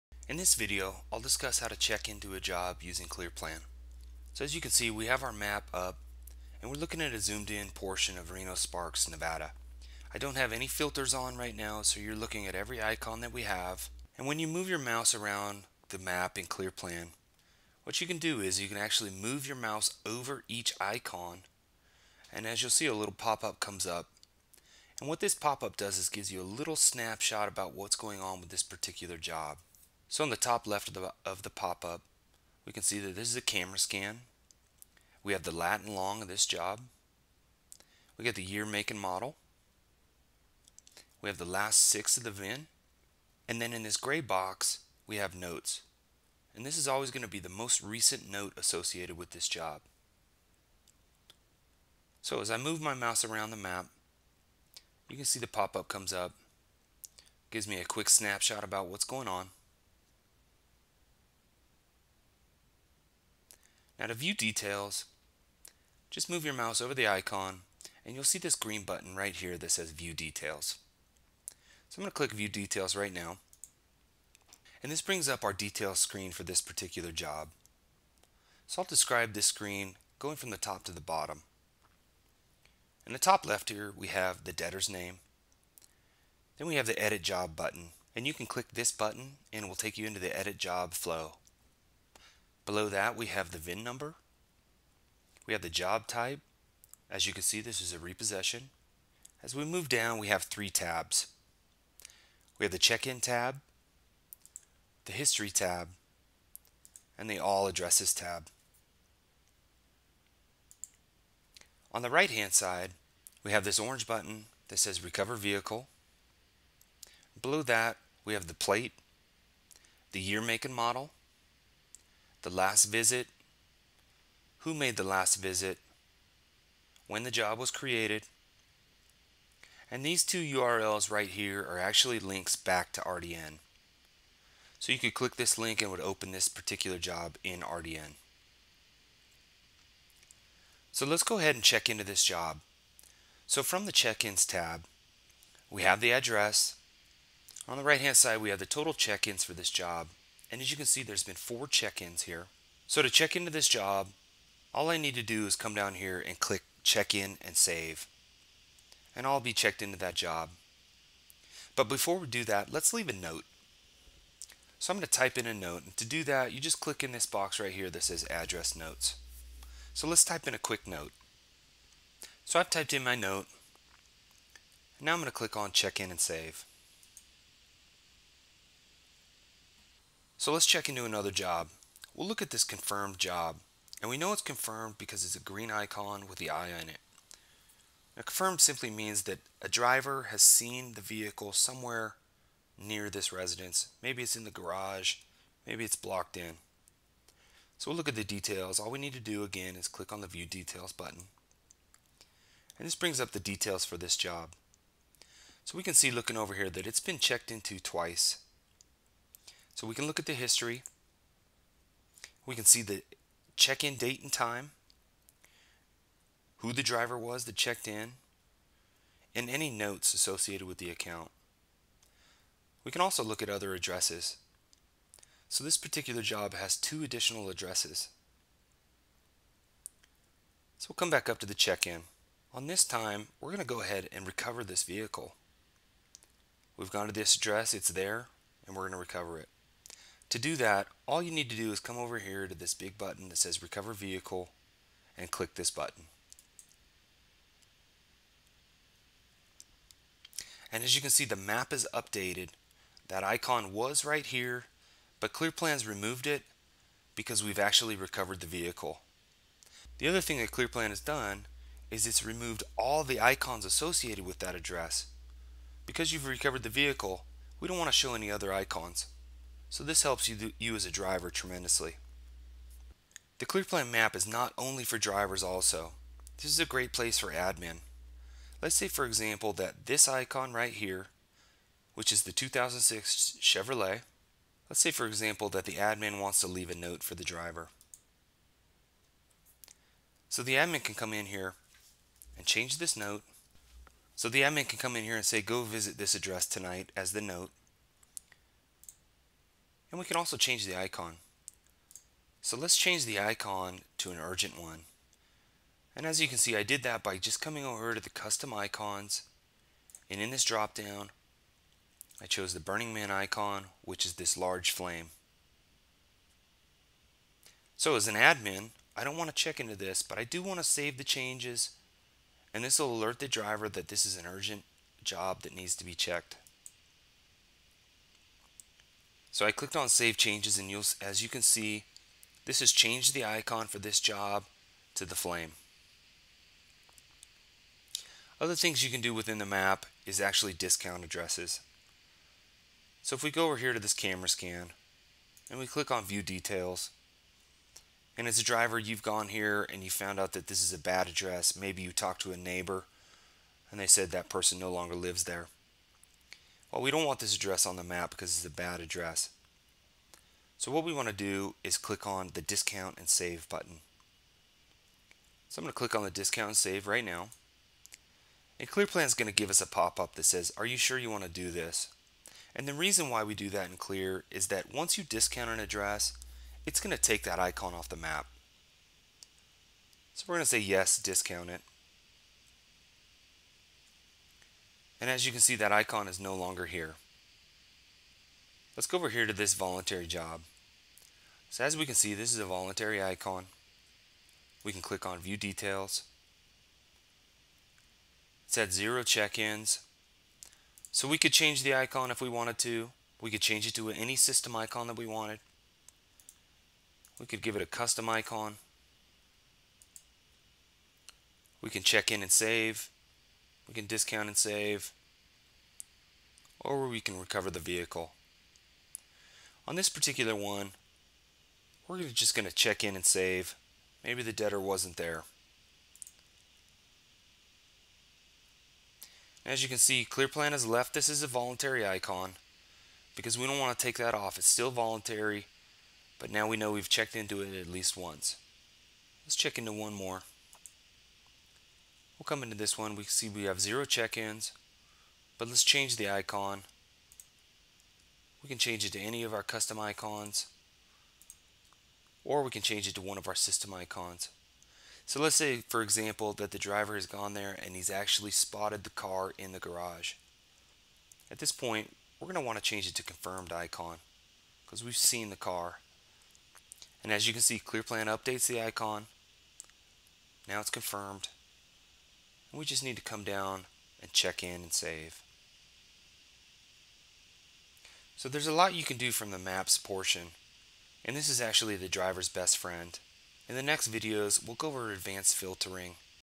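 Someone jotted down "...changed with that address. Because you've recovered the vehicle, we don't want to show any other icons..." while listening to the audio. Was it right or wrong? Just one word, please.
wrong.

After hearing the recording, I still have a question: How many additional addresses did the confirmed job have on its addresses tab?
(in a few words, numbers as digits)
2.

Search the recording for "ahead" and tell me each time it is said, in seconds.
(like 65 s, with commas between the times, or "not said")
141 s, 233 s.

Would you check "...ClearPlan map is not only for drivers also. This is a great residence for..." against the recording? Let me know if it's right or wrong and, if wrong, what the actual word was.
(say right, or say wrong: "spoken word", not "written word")
wrong: "place", not "residence".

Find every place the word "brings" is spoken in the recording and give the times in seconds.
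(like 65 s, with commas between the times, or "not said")
75 s, 202 s.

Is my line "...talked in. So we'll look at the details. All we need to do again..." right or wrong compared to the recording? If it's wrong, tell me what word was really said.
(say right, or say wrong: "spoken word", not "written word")
wrong: "blocked", not "talked".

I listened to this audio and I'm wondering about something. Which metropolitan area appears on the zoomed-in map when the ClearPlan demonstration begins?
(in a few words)
Reno Sparks, Nevada.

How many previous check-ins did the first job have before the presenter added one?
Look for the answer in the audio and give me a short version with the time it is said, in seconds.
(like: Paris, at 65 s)
4, at 151 s.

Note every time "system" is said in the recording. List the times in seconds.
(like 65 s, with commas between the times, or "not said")
404 s, 453 s.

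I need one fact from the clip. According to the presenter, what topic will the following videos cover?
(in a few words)
Advanced filtering.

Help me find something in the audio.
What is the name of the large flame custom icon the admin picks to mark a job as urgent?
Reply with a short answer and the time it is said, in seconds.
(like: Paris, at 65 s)
Burning Man, at 312 s.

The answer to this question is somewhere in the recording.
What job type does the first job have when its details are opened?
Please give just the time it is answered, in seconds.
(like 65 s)
97 s.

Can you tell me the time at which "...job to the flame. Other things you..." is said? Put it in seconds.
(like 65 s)
333 s.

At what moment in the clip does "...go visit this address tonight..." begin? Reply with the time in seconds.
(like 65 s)
295 s.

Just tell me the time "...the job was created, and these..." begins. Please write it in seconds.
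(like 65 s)
127 s.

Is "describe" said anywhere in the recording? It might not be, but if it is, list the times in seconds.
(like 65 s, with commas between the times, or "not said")
78 s.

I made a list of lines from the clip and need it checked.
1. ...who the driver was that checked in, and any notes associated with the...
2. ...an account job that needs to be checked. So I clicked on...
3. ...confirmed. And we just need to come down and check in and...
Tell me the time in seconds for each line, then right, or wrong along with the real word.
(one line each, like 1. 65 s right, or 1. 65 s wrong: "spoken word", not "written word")
1. 216 s right
2. 324 s wrong: "urgent", not "account"
3. 470 s right.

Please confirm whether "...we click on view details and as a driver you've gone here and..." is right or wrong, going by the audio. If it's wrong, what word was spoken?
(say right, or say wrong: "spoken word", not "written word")
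right.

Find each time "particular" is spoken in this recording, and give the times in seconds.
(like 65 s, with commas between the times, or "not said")
28 s, 76 s, 136 s, 225 s, 419 s.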